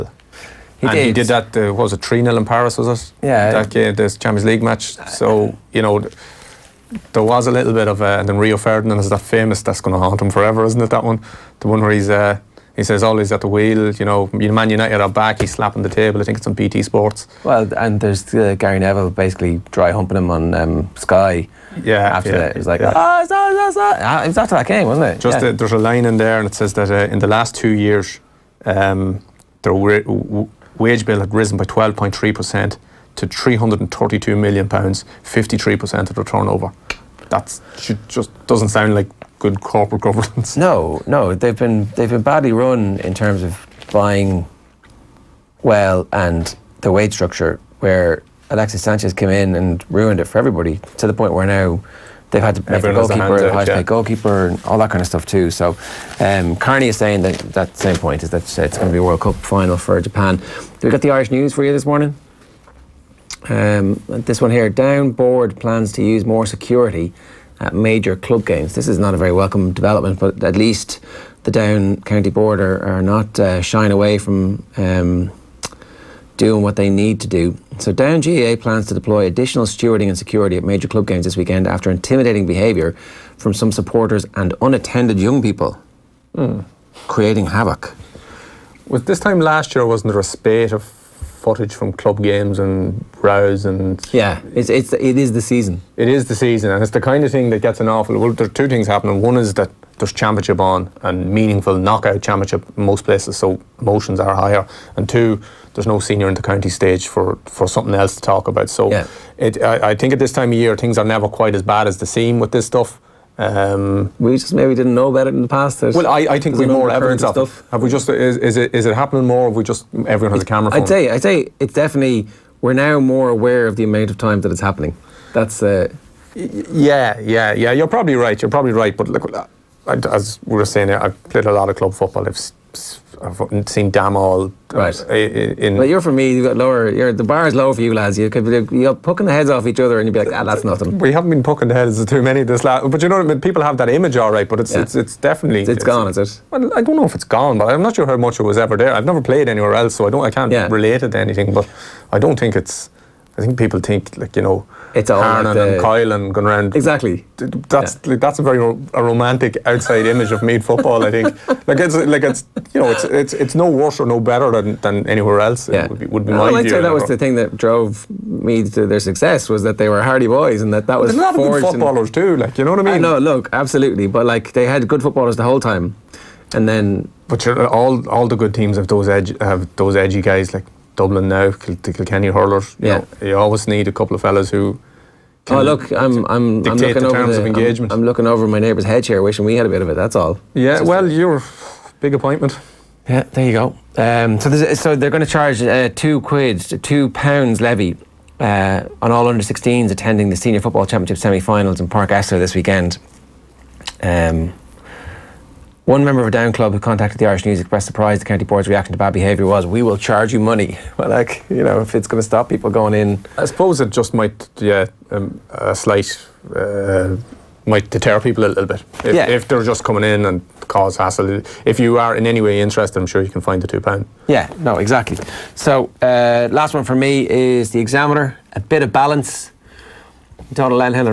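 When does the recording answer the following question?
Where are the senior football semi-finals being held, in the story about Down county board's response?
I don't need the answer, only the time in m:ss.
3:21.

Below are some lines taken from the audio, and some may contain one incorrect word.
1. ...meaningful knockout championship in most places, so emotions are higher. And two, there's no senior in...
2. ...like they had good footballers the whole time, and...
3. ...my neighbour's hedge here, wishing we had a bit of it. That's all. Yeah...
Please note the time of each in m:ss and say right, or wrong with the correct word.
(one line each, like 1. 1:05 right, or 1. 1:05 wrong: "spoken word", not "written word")
1. 1:41 right
2. 2:54 right
3. 3:08 right.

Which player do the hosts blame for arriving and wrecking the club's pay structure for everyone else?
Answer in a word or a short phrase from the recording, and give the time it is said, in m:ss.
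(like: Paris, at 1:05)
Alexis Sanchez, at 0:48.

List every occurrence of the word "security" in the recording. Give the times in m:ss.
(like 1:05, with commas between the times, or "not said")
1:06, 1:20.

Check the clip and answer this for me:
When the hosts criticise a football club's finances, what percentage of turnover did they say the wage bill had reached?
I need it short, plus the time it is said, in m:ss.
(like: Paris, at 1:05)
53%, at 0:35.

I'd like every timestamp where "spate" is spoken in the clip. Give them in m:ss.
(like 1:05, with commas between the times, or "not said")
1:30.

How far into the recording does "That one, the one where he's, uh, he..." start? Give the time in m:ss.
0:10.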